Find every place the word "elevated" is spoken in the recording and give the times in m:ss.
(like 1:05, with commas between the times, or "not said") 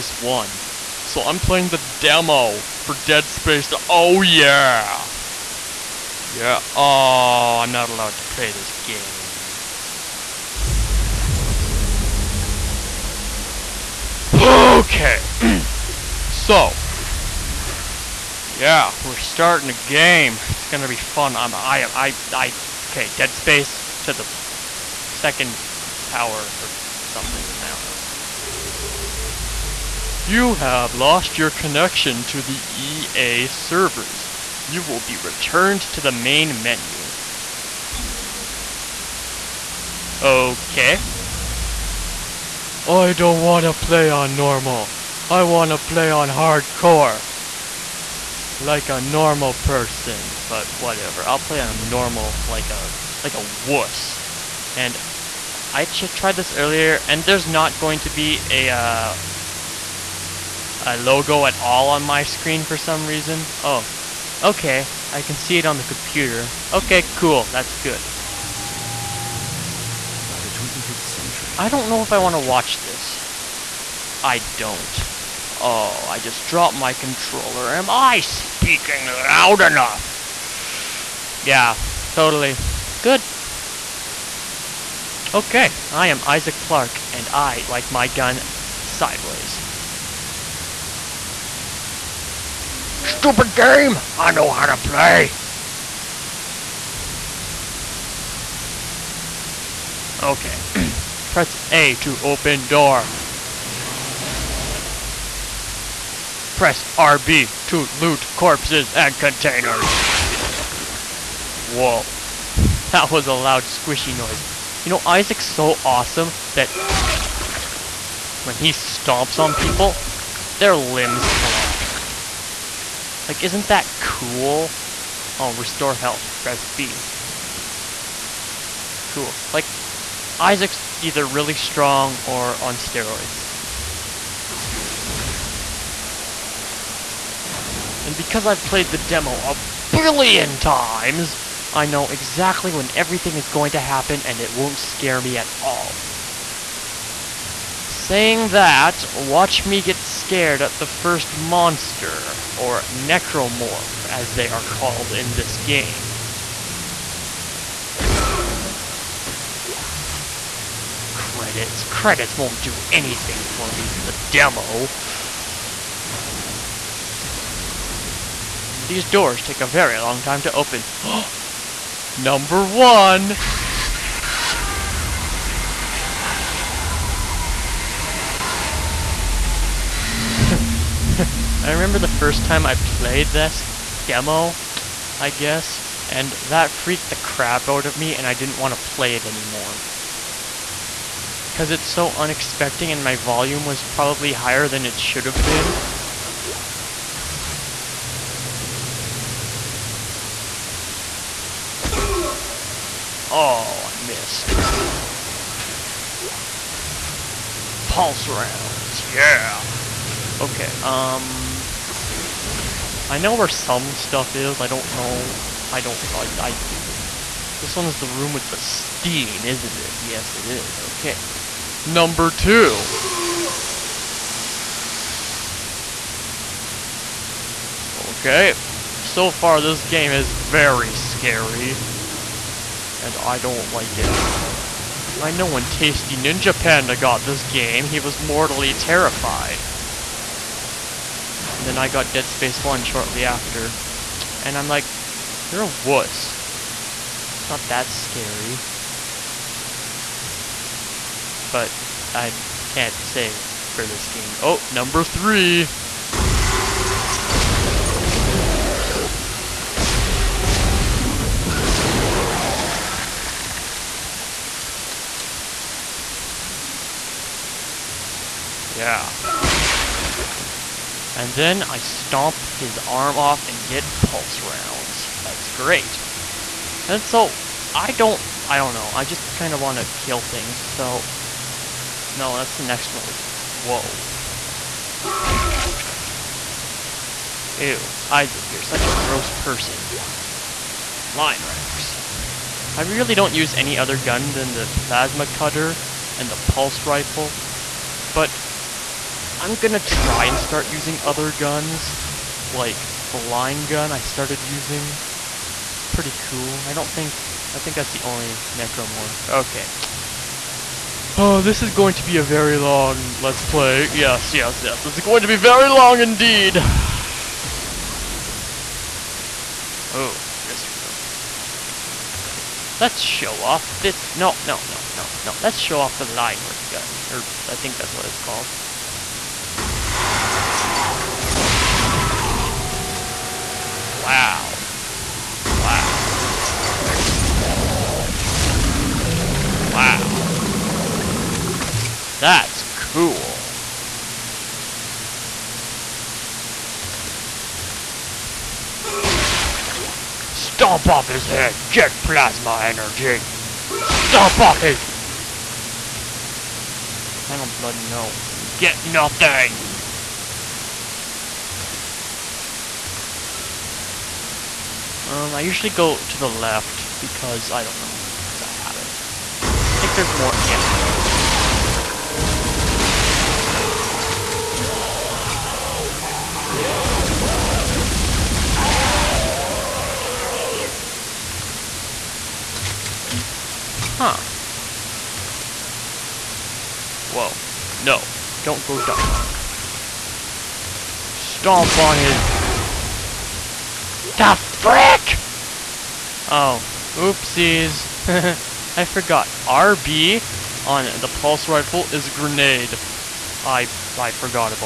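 not said.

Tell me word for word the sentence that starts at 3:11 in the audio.
Because it's so unexpected and my volume was probably higher than it should have been.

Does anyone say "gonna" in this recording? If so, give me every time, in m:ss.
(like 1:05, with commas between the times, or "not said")
0:20, 4:59.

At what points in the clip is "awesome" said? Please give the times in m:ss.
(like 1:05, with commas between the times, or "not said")
1:55.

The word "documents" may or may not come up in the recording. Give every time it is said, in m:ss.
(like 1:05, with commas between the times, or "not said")
not said.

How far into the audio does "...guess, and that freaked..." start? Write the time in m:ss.
3:05.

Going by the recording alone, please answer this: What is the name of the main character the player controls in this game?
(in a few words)
Isaac Clark.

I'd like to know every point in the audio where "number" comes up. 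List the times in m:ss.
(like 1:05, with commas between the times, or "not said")
2:52, 3:41, 4:14.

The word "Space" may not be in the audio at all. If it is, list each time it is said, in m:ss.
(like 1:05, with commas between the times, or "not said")
0:03, 0:23, 4:02.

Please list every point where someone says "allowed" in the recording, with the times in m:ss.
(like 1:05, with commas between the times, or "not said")
0:07.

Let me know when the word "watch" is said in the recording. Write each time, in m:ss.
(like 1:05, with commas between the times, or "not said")
1:12, 2:29.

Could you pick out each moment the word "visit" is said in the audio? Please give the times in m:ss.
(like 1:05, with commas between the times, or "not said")
not said.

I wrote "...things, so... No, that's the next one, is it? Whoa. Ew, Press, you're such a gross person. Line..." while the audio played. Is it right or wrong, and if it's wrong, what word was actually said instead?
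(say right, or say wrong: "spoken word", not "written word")
wrong: "Isaac", not "Press".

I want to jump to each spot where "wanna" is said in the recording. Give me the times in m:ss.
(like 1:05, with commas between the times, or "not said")
0:45.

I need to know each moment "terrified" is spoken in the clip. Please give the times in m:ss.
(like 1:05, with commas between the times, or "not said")
3:58.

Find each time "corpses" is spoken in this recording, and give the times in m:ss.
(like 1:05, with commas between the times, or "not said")
1:48.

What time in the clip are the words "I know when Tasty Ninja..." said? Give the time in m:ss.
3:55.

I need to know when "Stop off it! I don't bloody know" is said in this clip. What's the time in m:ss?
5:53.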